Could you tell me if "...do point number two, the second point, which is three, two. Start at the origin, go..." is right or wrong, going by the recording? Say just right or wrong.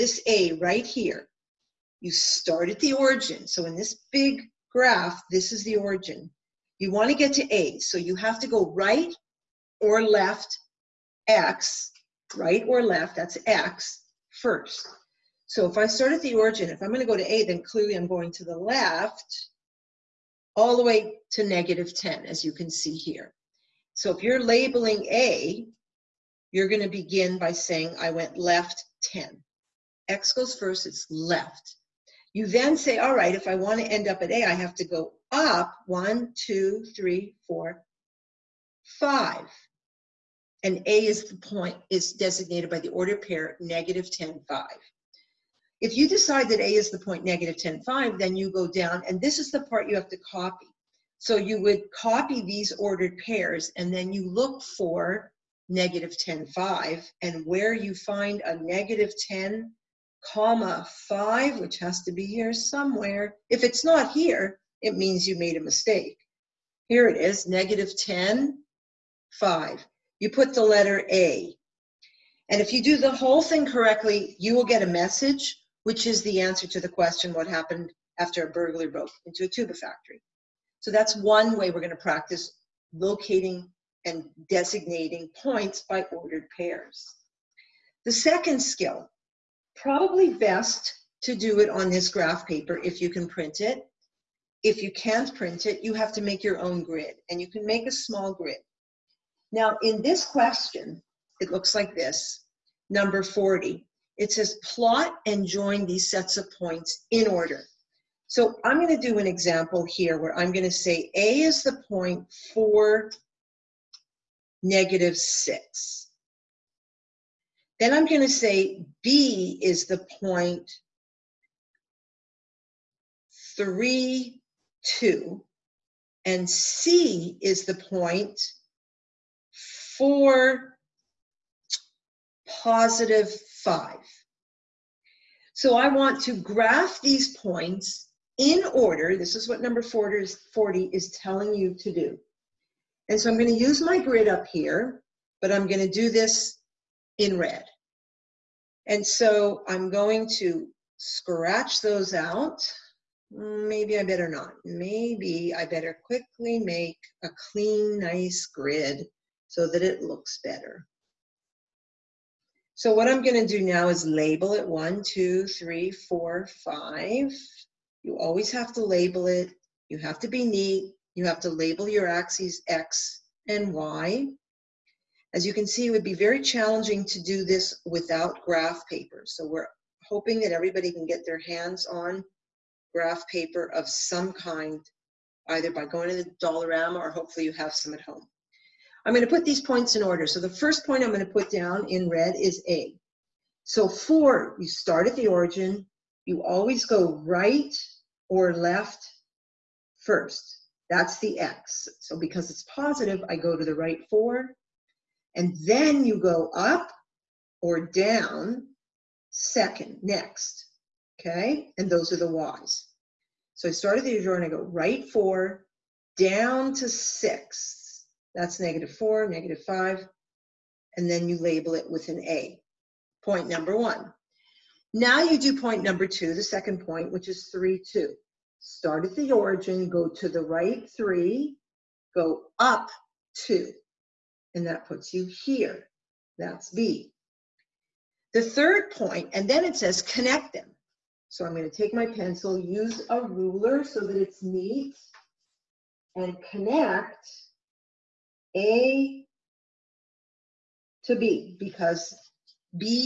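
right.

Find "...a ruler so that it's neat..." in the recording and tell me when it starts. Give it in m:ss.
4:03.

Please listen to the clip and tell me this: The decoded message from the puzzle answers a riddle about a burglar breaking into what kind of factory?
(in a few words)
tuba factory.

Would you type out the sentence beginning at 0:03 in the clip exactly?
So in this big graph, this is the origin.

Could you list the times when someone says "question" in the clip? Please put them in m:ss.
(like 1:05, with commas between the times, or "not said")
1:16, 1:40.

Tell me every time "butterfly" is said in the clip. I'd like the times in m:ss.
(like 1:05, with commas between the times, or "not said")
not said.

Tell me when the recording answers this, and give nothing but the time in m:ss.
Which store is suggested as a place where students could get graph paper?
3:06.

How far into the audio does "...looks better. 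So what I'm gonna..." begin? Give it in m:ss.
2:40.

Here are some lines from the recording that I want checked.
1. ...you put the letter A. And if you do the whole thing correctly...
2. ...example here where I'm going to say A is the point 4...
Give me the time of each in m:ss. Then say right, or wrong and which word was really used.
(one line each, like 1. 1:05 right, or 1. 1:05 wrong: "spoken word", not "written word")
1. 1:10 right
2. 1:49 right.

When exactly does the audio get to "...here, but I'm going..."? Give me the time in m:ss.
2:24.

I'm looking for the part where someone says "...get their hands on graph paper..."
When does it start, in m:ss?
3:01.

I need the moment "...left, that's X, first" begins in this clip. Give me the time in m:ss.
0:12.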